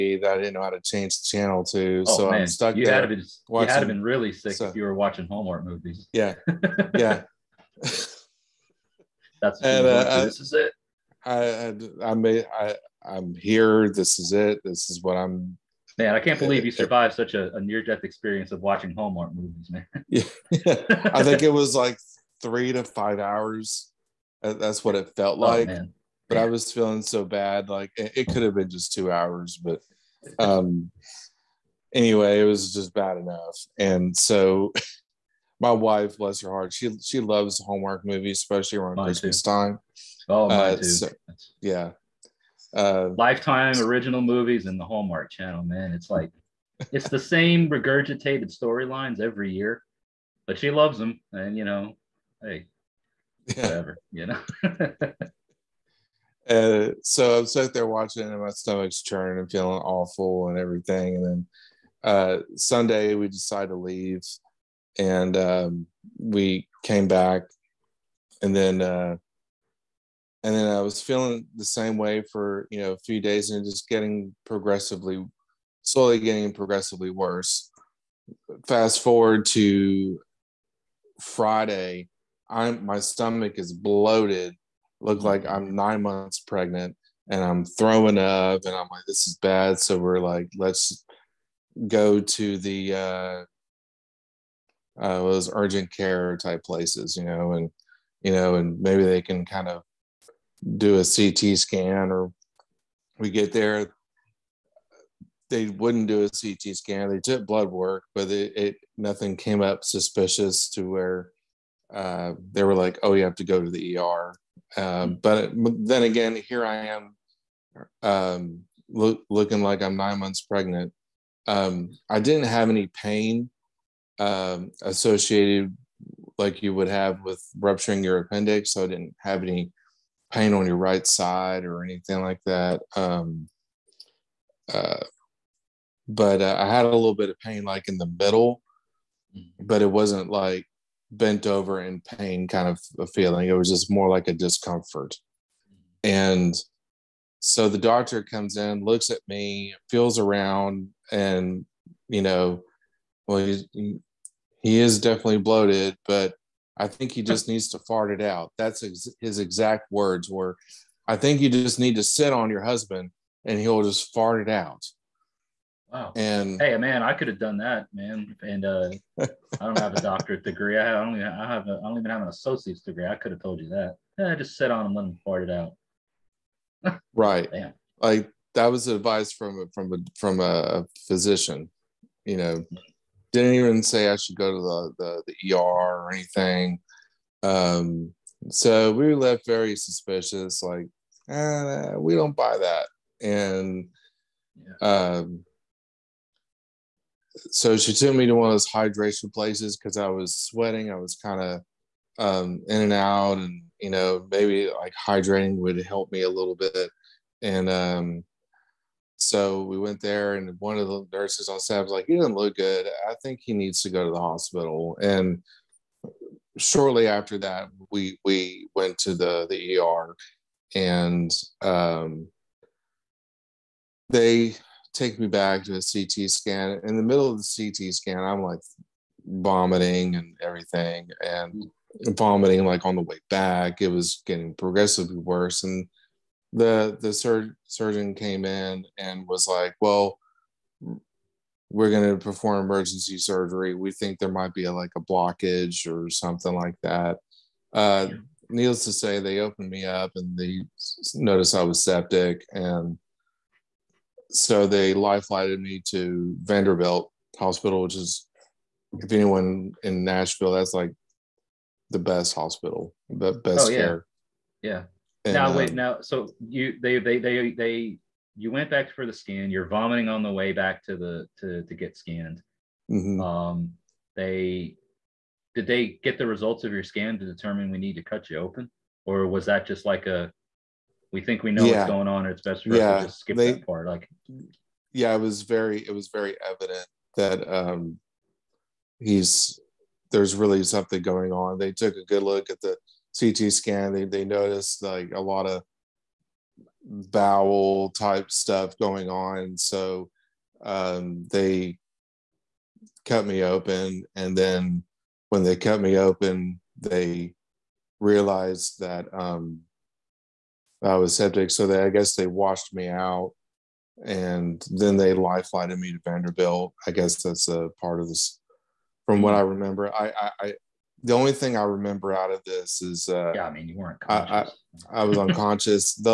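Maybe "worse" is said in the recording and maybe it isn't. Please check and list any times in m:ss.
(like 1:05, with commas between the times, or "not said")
1:17, 3:55.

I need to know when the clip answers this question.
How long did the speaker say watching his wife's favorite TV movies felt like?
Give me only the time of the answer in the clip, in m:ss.
0:22.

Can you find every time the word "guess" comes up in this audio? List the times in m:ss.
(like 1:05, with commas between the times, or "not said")
5:11, 5:16.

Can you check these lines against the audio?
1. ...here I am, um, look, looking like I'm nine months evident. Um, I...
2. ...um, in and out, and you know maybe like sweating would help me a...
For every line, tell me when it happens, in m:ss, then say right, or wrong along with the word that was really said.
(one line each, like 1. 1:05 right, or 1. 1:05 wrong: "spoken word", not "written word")
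1. 1:56 wrong: "pregnant", not "evident"
2. 3:22 wrong: "hydrating", not "sweating".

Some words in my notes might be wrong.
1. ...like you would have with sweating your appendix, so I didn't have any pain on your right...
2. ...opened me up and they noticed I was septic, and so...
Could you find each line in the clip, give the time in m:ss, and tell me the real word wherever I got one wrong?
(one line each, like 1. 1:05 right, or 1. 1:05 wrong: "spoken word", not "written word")
1. 2:06 wrong: "rupturing", not "sweating"
2. 4:09 right.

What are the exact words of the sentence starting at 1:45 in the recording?
They wouldn't do a CT scan.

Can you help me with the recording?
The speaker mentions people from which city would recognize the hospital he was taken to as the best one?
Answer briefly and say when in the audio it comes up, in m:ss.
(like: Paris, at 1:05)
Nashville, at 4:20.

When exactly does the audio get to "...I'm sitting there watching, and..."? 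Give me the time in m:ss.
0:57.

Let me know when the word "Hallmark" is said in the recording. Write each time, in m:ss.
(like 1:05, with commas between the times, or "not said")
0:05, 0:18, 0:37, 0:44.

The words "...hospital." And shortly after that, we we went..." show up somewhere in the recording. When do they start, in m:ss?
3:34.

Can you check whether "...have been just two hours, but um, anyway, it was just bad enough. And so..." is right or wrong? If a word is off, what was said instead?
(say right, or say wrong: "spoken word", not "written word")
right.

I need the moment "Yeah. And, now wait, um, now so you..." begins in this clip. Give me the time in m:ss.
4:24.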